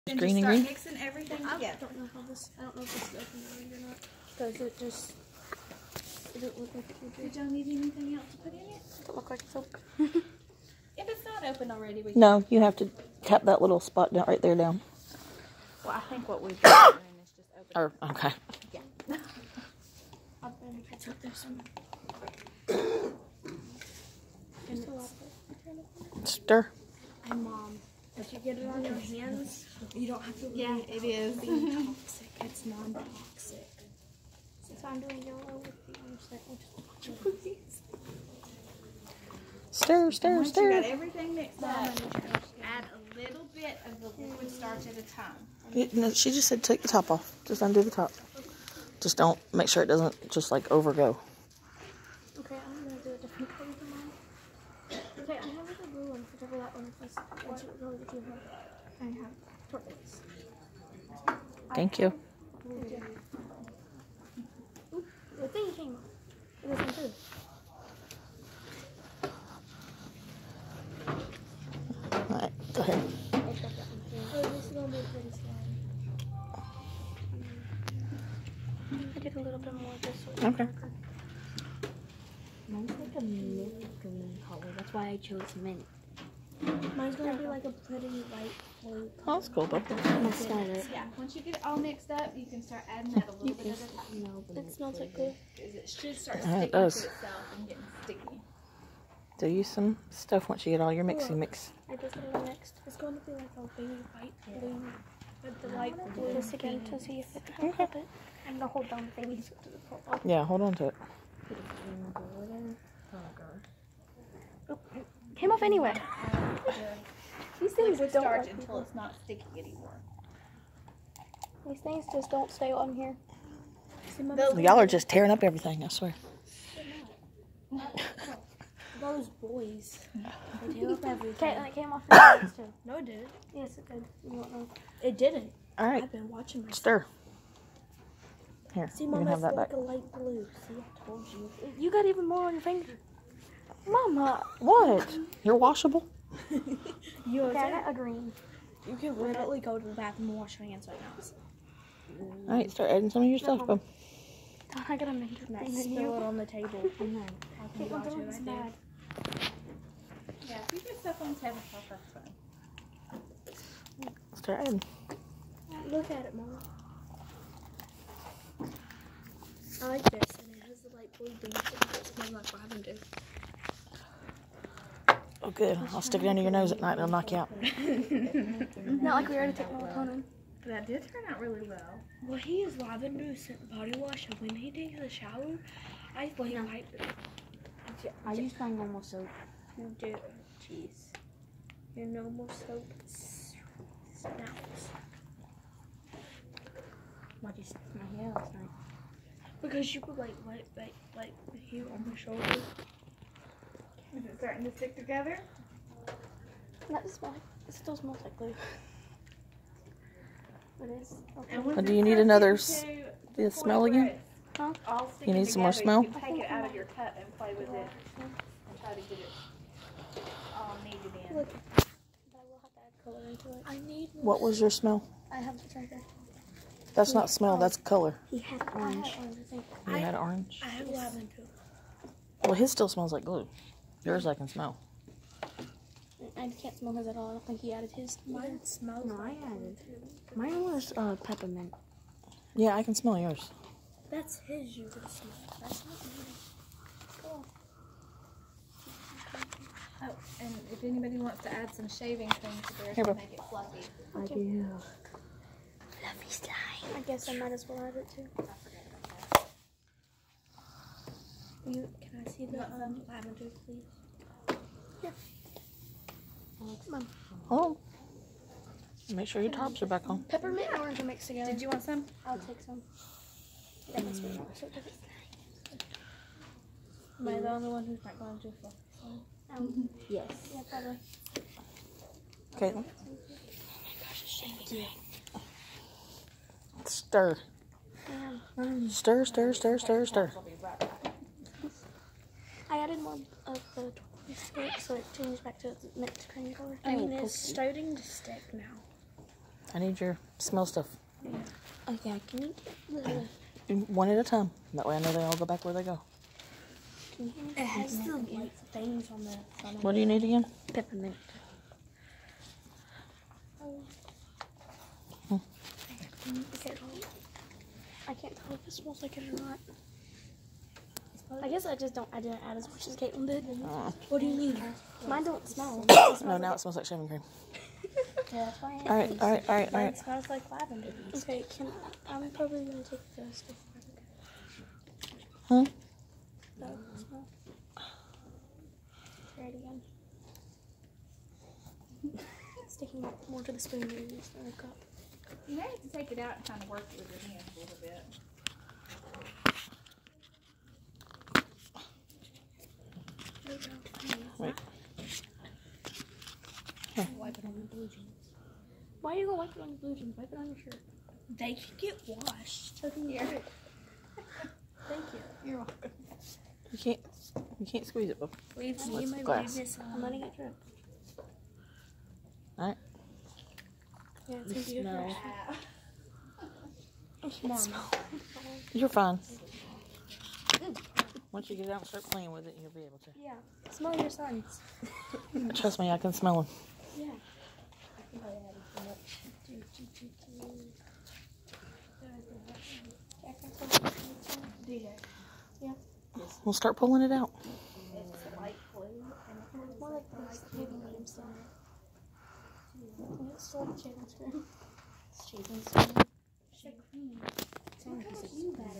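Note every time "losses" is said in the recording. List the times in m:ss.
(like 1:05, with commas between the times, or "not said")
not said.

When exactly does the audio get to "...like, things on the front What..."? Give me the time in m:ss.
5:08.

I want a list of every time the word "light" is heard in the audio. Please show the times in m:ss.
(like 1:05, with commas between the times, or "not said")
1:28, 1:45, 2:19, 2:50.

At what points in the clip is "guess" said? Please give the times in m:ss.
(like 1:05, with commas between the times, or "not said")
4:17, 5:21.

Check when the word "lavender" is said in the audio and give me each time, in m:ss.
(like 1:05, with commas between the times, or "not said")
2:52, 3:02, 4:23, 5:30.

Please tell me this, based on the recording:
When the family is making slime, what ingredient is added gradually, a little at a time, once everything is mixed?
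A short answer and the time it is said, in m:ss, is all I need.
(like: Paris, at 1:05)
liquid starch, at 0:44.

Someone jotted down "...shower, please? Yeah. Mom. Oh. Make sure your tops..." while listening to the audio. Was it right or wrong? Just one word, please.
wrong.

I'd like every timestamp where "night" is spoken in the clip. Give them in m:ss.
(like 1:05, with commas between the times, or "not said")
2:56, 3:18.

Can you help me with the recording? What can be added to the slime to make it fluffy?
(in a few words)
shaving things.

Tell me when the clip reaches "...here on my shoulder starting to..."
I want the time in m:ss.
3:21.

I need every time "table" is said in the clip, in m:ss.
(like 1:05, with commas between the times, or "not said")
2:36, 2:41.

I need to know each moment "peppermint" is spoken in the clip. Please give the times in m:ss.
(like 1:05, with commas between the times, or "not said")
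4:01, 4:30, 5:10.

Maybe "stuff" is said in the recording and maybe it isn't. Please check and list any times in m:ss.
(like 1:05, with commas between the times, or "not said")
1:40, 2:33, 2:40, 5:00, 5:33.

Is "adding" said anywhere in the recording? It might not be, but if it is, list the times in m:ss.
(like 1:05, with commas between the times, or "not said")
1:32, 2:32, 2:44.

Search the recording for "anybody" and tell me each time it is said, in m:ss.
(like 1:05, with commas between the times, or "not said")
4:10.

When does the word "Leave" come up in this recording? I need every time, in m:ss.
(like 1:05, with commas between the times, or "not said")
6:08.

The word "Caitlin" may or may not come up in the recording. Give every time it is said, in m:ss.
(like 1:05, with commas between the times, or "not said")
4:42, 5:22.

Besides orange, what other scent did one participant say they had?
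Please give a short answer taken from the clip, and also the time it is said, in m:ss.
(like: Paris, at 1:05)
lemon, at 3:50.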